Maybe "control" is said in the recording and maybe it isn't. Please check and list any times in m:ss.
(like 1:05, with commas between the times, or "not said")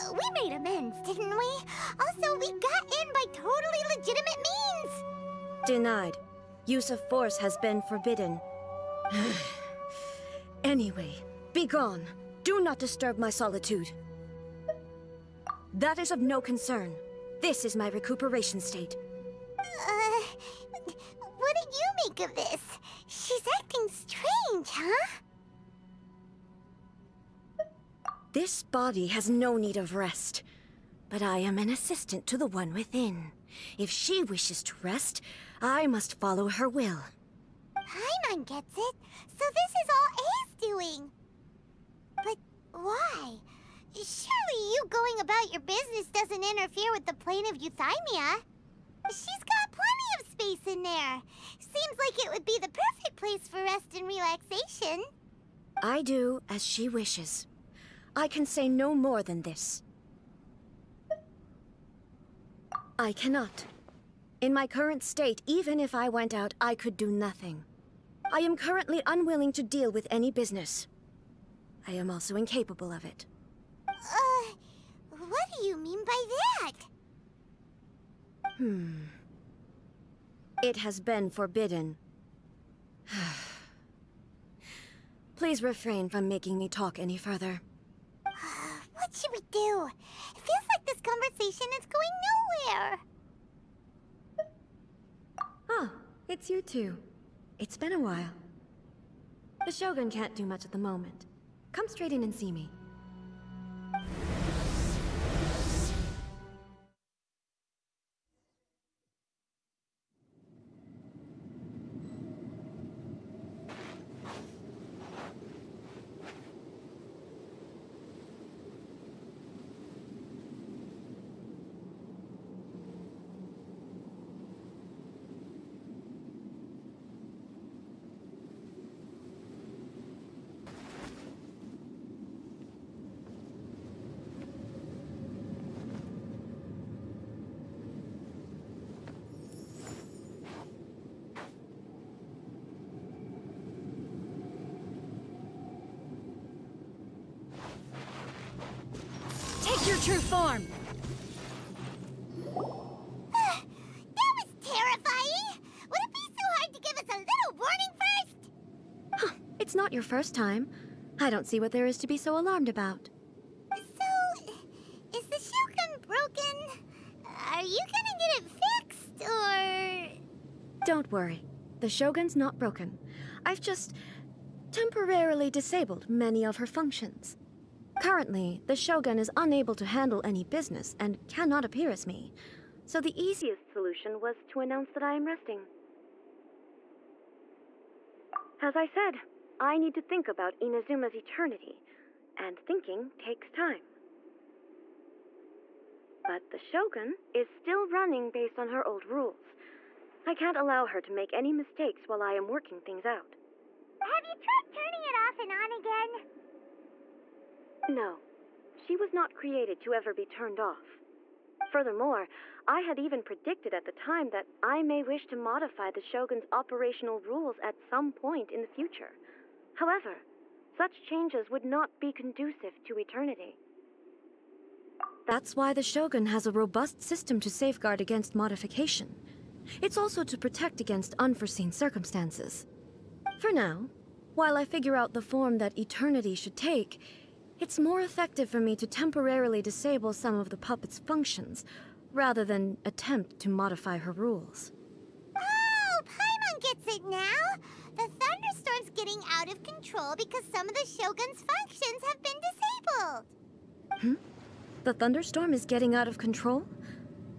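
4:09, 4:16.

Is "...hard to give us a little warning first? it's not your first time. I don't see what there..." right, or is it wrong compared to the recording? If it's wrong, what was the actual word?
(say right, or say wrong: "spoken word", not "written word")
right.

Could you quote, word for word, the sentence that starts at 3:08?
As I said, I need to think about Inazuma's eternity, and thinking takes time.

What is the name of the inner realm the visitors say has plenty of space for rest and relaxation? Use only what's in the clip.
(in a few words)
plane of euthymia.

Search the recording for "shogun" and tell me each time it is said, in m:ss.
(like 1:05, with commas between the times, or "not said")
1:39, 2:45, 2:51, 2:58, 3:16, 3:35, 3:45, 4:10.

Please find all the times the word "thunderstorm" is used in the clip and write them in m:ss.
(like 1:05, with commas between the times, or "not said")
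4:08, 4:14.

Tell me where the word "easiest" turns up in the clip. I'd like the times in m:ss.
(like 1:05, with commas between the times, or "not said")
3:03.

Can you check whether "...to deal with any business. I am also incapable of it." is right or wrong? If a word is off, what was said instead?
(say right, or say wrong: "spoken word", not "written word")
right.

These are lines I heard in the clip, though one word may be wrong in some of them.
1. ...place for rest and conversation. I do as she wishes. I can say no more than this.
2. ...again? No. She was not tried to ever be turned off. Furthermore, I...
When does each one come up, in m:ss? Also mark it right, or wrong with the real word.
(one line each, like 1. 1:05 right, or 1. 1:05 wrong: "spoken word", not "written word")
1. 0:53 wrong: "relaxation", not "conversation"
2. 3:25 wrong: "created", not "tried".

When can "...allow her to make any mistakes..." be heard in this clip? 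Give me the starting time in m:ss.
3:20.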